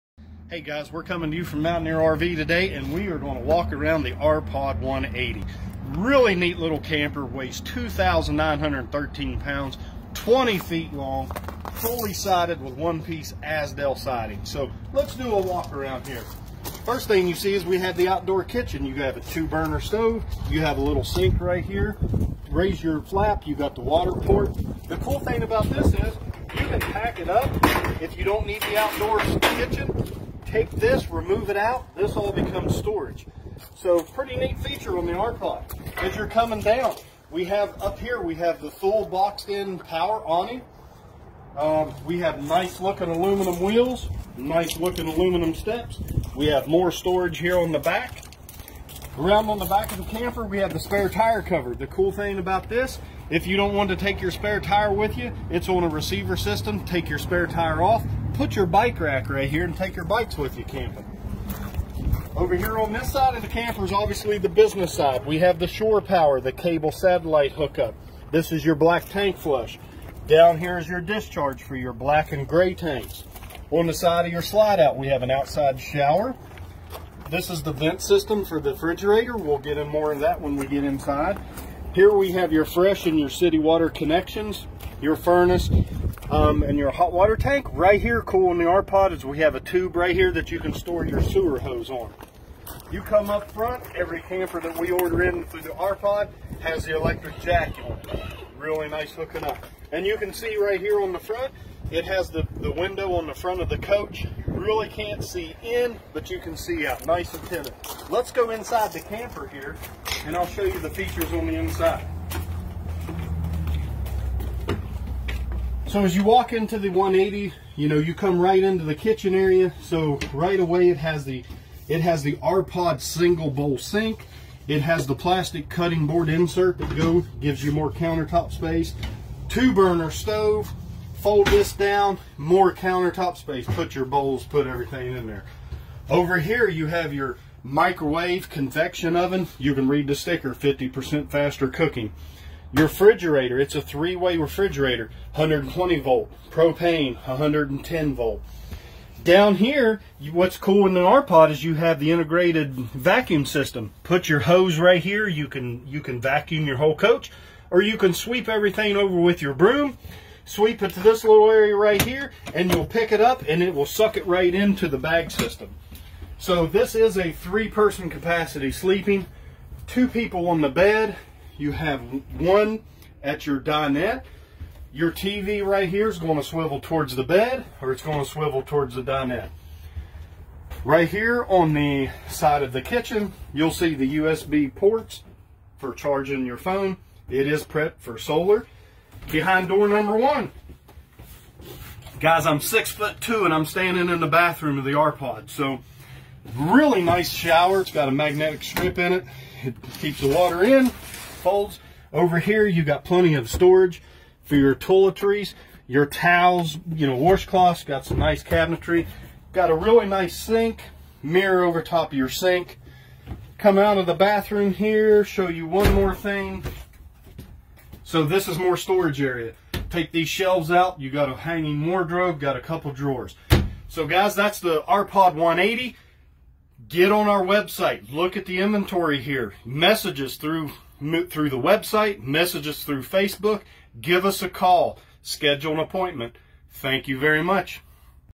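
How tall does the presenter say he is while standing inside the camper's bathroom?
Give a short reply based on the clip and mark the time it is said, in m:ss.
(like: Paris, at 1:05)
6 foot 2, at 3:12.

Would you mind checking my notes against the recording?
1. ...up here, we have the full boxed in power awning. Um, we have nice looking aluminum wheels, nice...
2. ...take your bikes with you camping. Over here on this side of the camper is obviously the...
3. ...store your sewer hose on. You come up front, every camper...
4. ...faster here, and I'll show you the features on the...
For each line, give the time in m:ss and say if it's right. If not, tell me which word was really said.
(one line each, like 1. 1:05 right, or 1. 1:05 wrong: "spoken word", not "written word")
1. 0:37 right
2. 0:59 right
3. 1:30 right
4. 1:49 wrong: "camper", not "faster".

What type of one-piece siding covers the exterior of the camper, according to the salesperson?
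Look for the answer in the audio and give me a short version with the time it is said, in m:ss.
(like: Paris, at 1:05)
Azdel, at 0:13.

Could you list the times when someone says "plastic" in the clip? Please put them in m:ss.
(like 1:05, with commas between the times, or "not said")
2:05.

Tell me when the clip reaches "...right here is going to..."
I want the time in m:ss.
2:55.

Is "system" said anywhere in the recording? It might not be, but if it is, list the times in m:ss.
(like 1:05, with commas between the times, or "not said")
0:56, 1:18, 2:33, 2:45.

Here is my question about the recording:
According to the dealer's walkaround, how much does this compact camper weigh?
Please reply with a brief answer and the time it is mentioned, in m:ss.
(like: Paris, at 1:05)
2,913 pounds, at 0:07.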